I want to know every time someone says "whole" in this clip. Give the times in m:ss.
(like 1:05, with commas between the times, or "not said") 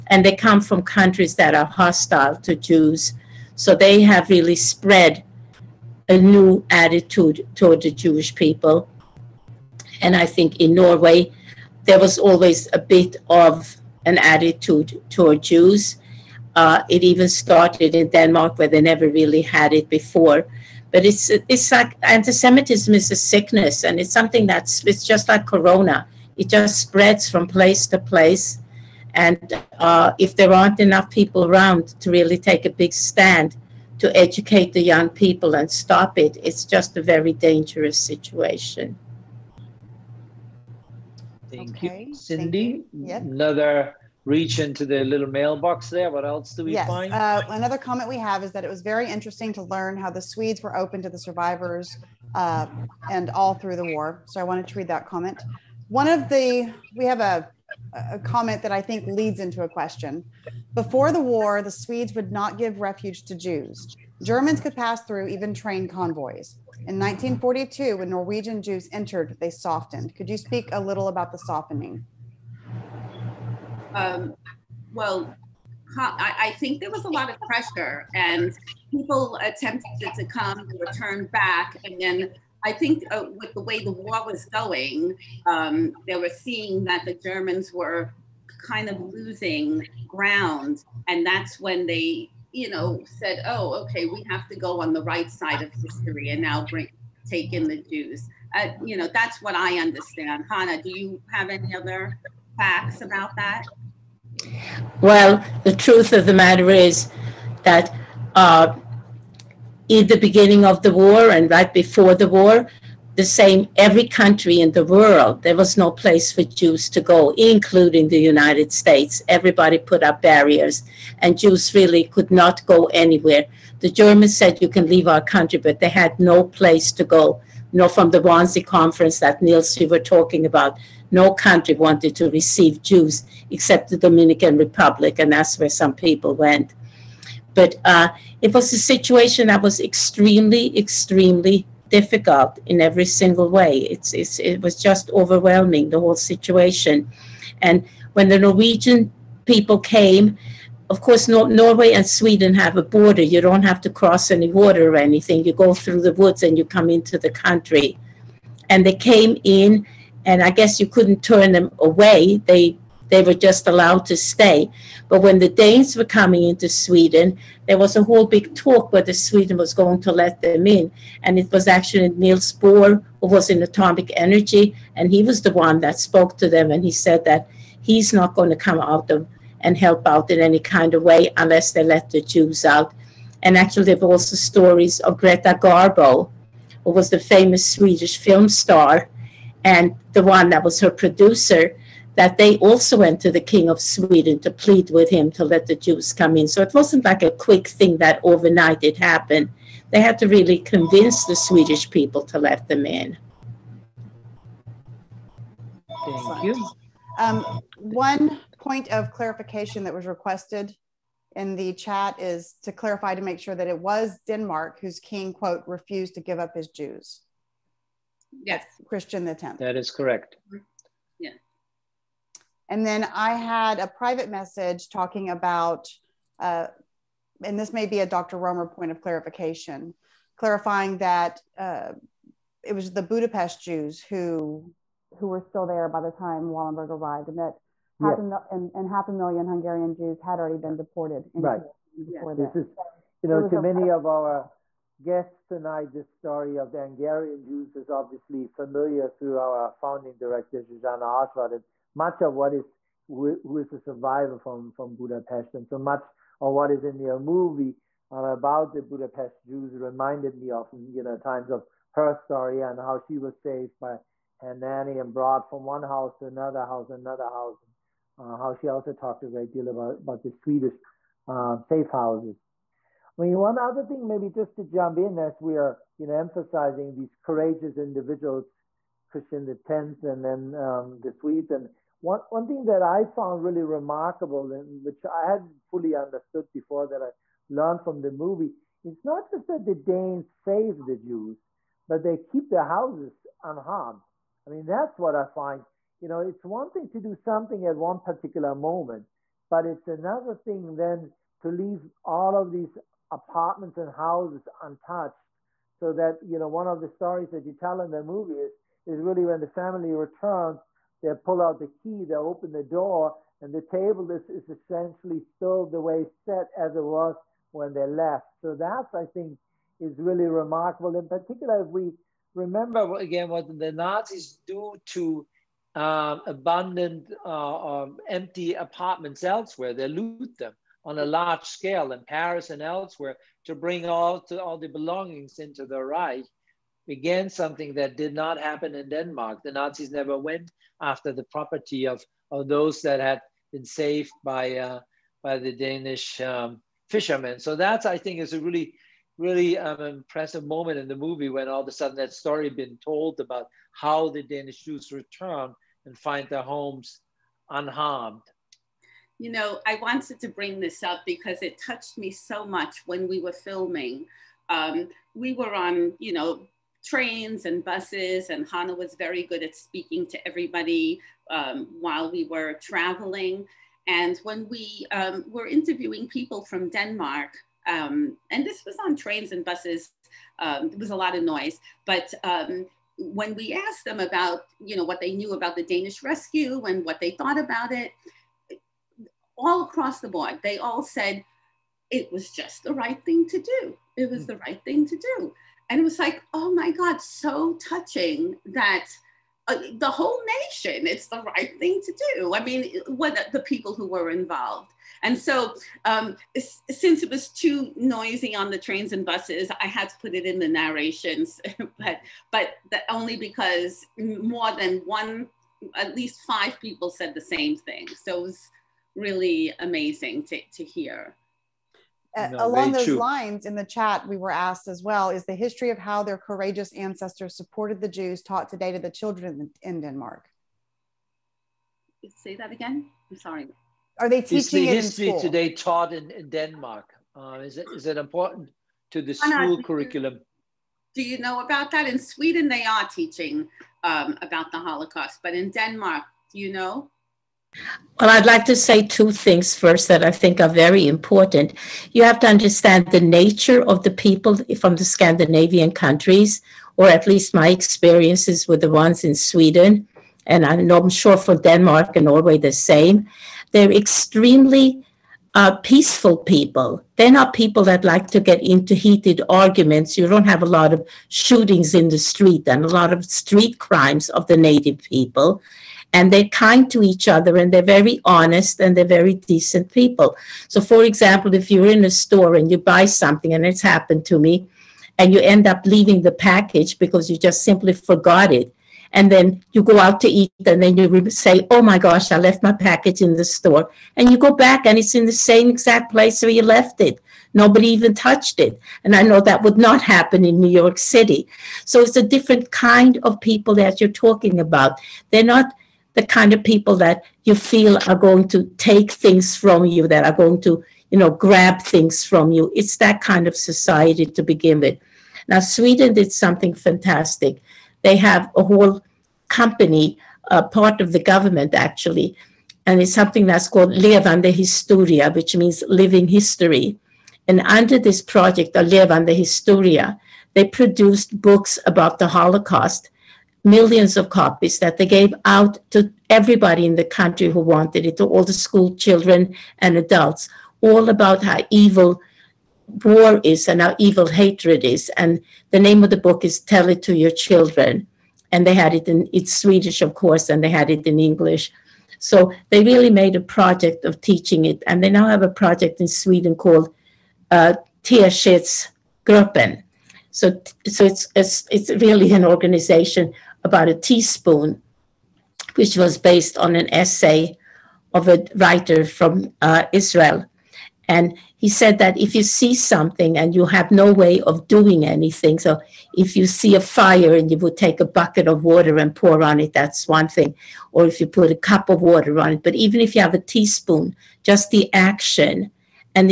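2:25, 2:48, 6:39, 8:38.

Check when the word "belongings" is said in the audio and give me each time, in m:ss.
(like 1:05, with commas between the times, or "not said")
5:34.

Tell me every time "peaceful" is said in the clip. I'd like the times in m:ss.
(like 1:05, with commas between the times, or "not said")
7:45.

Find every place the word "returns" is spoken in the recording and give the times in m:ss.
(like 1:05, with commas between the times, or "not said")
5:09, 5:54.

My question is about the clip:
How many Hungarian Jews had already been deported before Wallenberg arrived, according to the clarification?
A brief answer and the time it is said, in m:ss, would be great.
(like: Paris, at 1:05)
half a million, at 3:58.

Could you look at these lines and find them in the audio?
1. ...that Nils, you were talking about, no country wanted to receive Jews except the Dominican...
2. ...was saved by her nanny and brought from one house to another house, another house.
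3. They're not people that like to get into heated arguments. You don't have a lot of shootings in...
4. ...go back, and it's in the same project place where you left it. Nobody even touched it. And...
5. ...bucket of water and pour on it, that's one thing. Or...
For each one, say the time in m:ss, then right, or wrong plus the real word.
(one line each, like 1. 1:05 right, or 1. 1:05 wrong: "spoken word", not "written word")
1. 2:09 right
2. 4:23 right
3. 7:46 right
4. 8:14 wrong: "exact", not "project"
5. 9:37 right.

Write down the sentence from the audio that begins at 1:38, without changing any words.
Uh, you know, that's what I understand.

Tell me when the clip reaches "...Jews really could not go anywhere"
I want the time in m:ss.
2:01.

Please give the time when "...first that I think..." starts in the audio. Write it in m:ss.
7:29.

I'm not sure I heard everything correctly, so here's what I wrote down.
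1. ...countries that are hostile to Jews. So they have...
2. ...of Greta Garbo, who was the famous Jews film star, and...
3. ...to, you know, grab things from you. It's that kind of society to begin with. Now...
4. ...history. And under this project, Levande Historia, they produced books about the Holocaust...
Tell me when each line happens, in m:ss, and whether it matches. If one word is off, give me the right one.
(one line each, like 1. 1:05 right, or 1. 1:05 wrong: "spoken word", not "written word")
1. 0:00 right
2. 3:05 wrong: "Swedish", not "Jews"
3. 8:30 right
4. 8:46 right.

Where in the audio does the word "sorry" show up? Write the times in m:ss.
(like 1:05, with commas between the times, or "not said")
7:13.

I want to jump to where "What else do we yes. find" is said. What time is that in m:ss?
0:46.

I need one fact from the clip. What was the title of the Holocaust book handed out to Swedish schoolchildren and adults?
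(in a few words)
Tell It to Your Children.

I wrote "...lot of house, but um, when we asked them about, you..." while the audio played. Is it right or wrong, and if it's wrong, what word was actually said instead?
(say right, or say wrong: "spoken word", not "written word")
wrong: "noise", not "house".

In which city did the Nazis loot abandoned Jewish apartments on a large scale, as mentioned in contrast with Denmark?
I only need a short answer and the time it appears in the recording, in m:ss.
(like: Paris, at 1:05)
Paris, at 5:32.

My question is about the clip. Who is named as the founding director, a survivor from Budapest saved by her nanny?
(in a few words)
Zsuzsanna Ozsváth.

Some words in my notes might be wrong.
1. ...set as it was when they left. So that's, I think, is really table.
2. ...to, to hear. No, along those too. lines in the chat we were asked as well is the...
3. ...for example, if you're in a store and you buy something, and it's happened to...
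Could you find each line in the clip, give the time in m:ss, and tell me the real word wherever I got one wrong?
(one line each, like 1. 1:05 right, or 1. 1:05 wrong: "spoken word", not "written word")
1. 5:16 wrong: "remarkable", not "table"
2. 7:00 right
3. 8:00 right.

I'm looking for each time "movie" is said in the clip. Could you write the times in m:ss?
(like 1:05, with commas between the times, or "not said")
4:17, 4:48, 5:08, 5:50.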